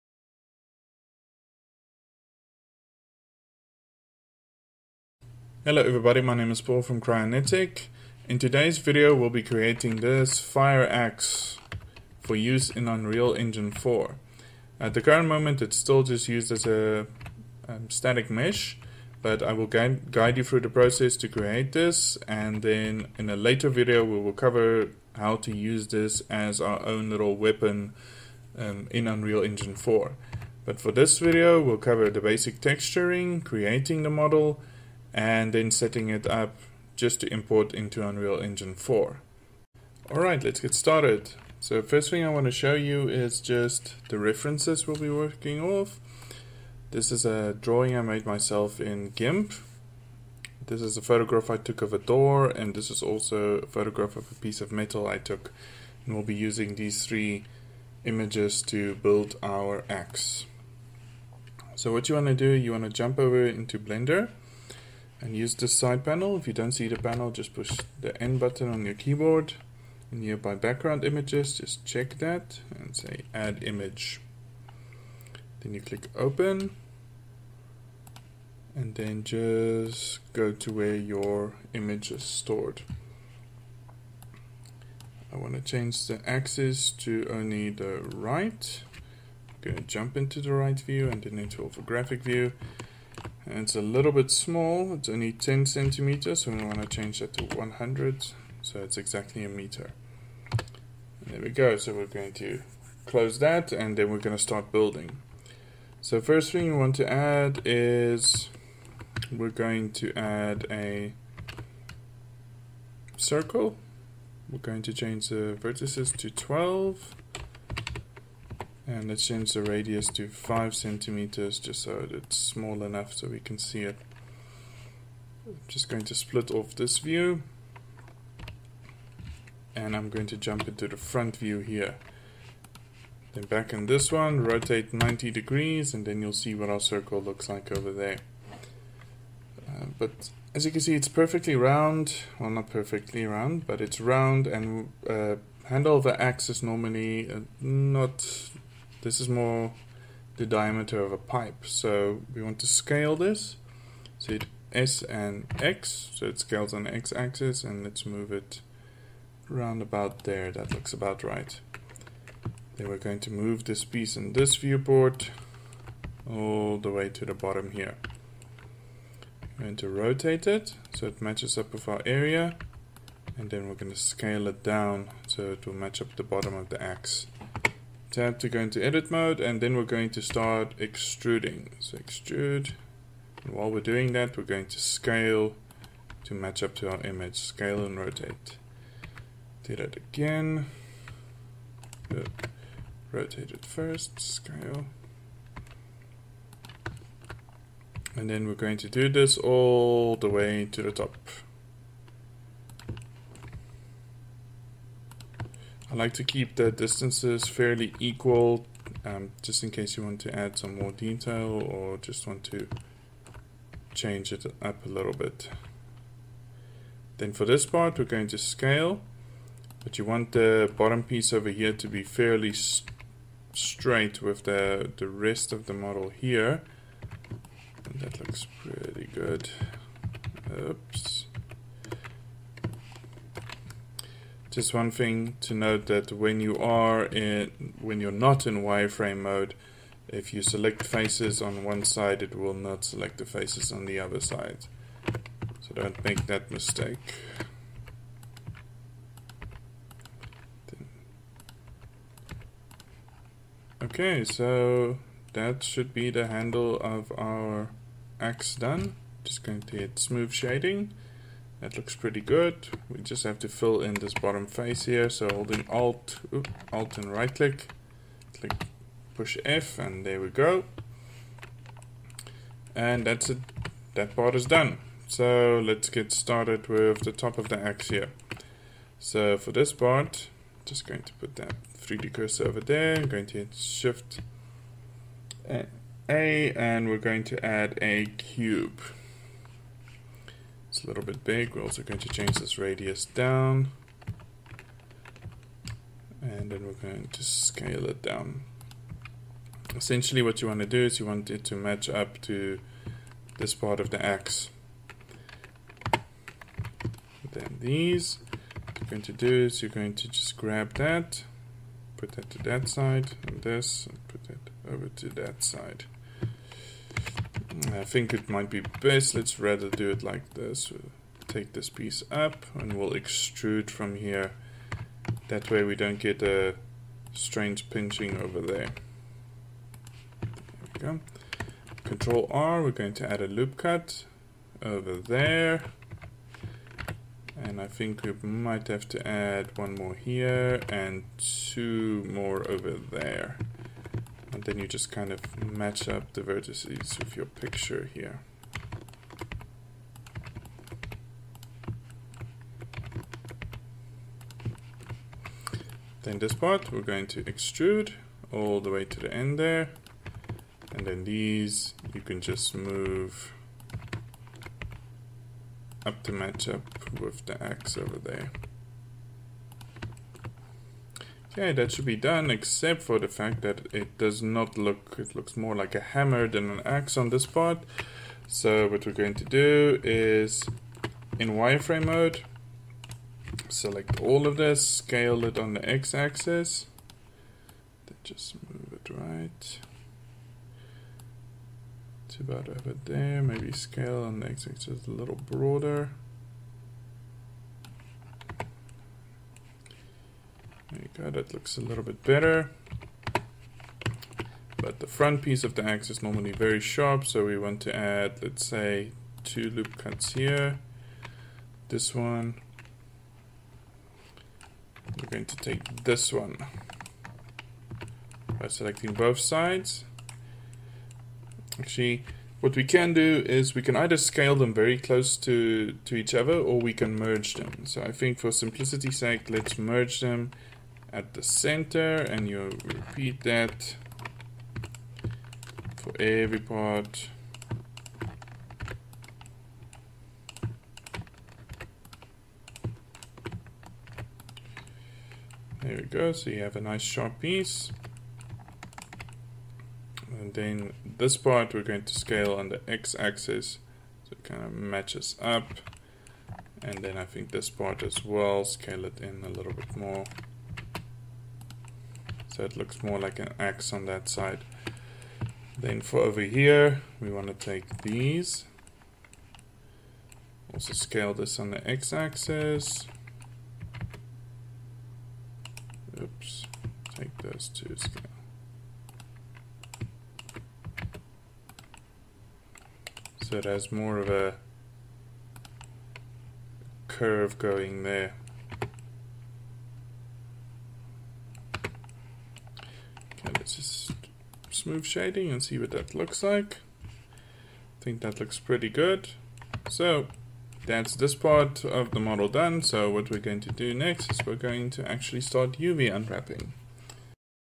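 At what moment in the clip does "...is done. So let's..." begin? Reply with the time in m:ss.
4:34.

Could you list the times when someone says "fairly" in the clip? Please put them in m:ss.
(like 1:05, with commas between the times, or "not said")
3:27, 3:42.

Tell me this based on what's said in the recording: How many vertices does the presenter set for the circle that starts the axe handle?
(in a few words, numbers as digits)
12.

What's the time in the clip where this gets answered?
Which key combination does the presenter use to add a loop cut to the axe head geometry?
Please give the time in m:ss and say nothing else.
5:31.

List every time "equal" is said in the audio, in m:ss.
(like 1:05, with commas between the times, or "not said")
3:27.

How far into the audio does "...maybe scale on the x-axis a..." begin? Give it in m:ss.
6:33.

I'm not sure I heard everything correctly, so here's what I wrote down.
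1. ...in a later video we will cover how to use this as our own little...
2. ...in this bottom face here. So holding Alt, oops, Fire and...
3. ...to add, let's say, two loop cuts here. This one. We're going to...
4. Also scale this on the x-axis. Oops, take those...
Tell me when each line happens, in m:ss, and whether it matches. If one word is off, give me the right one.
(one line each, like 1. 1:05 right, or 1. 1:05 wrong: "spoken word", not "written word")
1. 0:23 right
2. 4:23 wrong: "Alt", not "Fire"
3. 6:47 right
4. 7:50 right.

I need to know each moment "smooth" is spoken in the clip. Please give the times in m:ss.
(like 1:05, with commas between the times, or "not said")
4:19, 8:14.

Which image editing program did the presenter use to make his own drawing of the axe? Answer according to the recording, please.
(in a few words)
GIMP.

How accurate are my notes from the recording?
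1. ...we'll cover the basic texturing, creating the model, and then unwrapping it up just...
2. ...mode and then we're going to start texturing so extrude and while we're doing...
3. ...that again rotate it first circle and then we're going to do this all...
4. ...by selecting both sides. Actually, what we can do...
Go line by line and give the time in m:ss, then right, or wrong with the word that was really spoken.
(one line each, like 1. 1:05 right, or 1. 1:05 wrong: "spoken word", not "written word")
1. 0:31 wrong: "setting", not "unwrapping"
2. 2:59 wrong: "extruding", not "texturing"
3. 3:09 wrong: "scale", not "circle"
4. 6:58 right.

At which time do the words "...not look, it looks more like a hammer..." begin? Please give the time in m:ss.
6:14.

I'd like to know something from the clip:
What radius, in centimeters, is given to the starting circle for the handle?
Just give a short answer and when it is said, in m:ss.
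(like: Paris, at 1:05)
5 centimeters, at 2:00.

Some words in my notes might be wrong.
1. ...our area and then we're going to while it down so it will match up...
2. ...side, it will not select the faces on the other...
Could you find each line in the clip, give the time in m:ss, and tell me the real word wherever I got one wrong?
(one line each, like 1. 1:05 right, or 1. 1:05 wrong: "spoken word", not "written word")
1. 2:51 wrong: "scale", not "while"
2. 4:01 right.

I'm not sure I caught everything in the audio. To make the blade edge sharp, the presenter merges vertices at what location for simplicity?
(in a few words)
the center.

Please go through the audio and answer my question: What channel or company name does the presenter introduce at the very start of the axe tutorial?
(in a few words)
Cryonetic.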